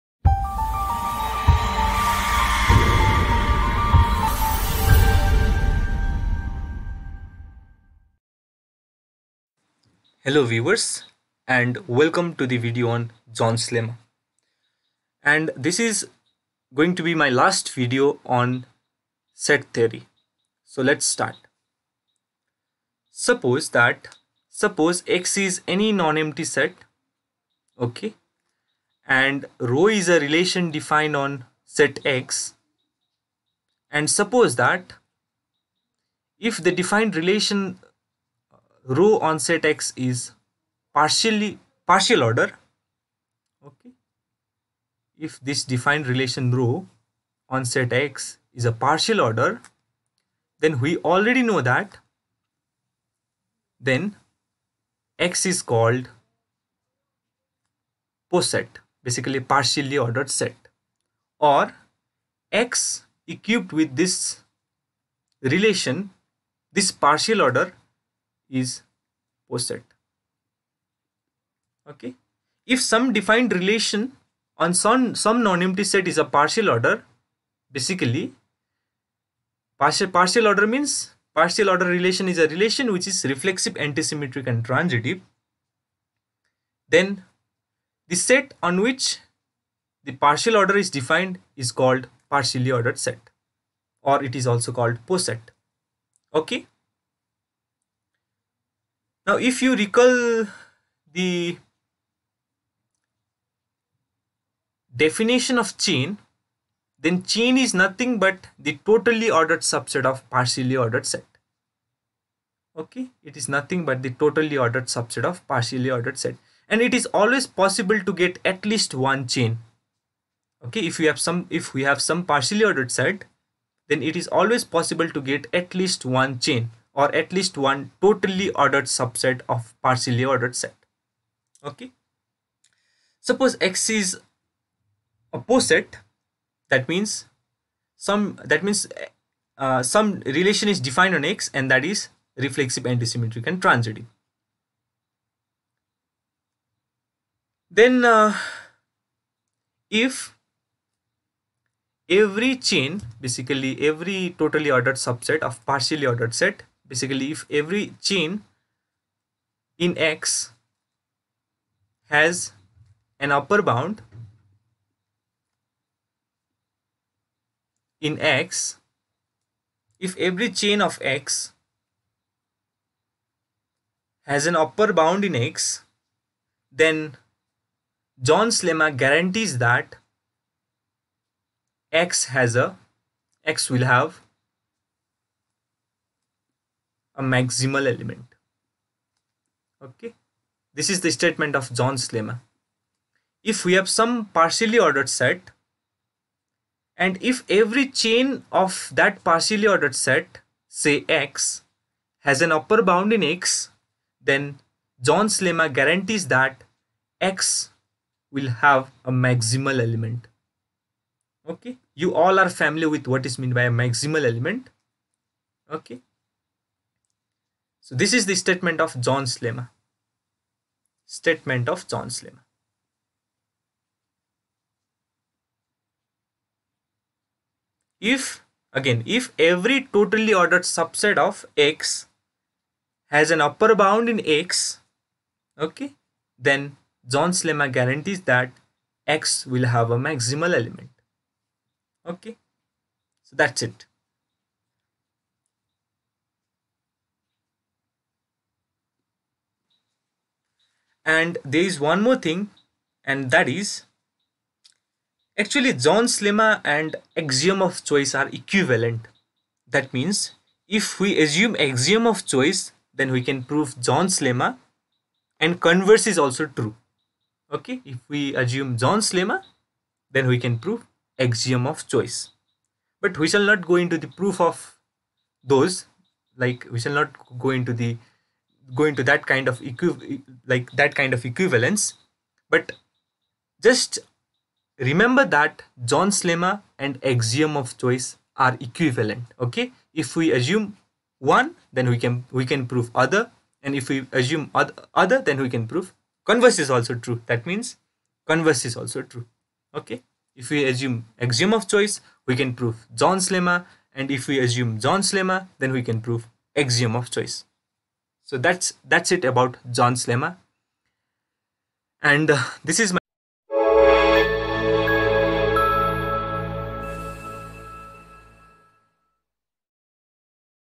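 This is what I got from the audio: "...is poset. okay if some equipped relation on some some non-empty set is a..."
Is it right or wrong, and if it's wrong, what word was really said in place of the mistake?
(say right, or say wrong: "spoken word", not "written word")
wrong: "defined", not "equipped".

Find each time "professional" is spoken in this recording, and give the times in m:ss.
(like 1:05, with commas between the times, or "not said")
not said.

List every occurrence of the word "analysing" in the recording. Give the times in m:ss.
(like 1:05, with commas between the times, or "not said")
not said.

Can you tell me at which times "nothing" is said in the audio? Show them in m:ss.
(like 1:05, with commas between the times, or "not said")
1:47, 1:53.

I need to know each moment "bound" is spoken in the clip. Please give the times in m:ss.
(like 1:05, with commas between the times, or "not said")
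2:43, 2:55, 3:22, 3:53.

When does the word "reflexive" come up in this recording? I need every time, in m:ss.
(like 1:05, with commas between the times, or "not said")
1:23, 2:22.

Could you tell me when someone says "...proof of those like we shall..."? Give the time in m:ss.
4:34.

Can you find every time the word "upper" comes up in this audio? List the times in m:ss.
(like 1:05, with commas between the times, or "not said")
2:43, 2:54, 3:22, 3:53.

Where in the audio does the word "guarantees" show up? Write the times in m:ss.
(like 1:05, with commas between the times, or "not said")
2:59, 3:25, 3:57.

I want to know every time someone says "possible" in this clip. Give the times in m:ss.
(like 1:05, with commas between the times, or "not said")
1:57, 2:04.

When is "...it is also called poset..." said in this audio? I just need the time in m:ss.
1:34.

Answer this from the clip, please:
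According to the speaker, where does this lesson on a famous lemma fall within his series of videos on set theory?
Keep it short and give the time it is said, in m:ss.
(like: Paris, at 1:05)
Last video, at 0:17.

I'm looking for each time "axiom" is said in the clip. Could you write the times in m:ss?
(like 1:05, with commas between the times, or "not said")
4:17, 4:21, 4:31, 4:47, 5:01, 5:06.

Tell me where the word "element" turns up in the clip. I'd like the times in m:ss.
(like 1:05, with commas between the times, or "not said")
3:07, 3:29, 3:34, 4:00.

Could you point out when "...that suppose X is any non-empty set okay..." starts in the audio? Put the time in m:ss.
0:23.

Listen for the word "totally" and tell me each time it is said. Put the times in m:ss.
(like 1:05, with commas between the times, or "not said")
1:48, 1:54, 2:08, 2:34, 3:49.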